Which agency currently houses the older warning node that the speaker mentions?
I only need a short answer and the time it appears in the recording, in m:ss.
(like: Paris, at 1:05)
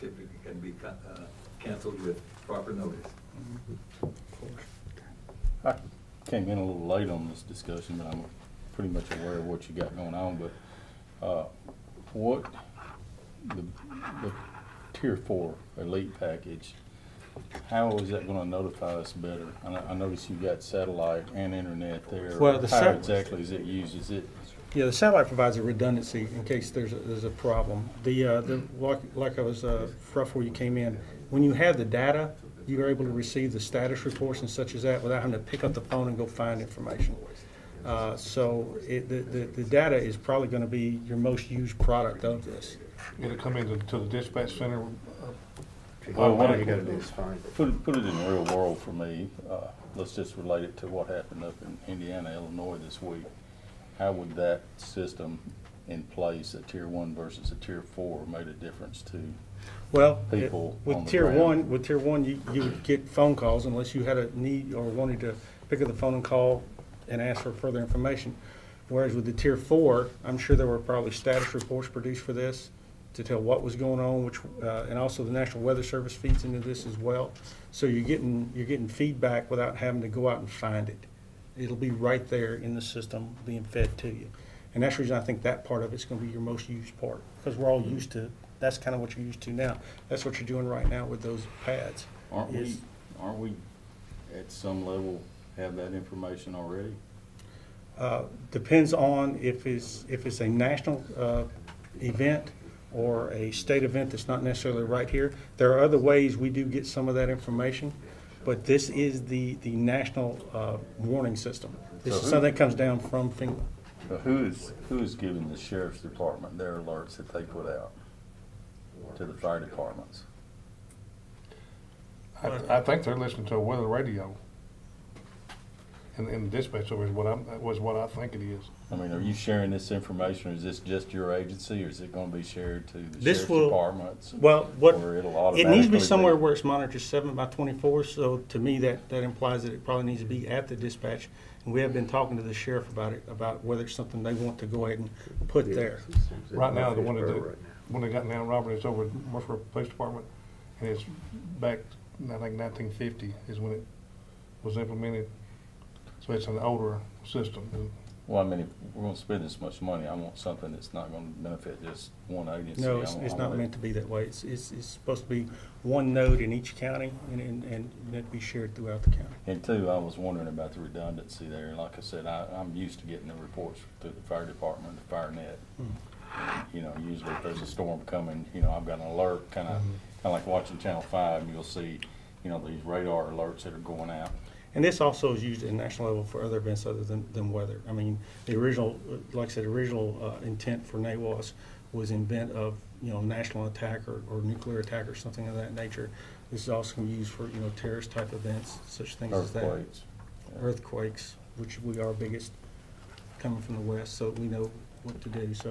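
Murfreesboro Police Department, at 2:29.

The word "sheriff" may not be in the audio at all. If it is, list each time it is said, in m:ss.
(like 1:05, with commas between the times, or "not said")
1:55, 2:13, 2:22.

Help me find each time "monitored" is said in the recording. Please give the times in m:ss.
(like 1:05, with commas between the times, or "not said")
2:16.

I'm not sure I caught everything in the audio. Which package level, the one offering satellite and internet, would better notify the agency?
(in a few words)
Tier four elite.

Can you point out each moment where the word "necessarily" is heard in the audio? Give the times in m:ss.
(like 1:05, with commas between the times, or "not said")
1:44.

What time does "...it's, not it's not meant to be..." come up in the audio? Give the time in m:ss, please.
2:43.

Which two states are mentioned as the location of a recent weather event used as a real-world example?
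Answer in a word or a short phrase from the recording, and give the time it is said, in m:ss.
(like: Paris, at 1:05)
Indiana, Illinois, at 0:51.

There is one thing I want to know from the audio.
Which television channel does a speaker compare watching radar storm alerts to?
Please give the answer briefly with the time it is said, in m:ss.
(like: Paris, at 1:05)
Channel 5, at 3:00.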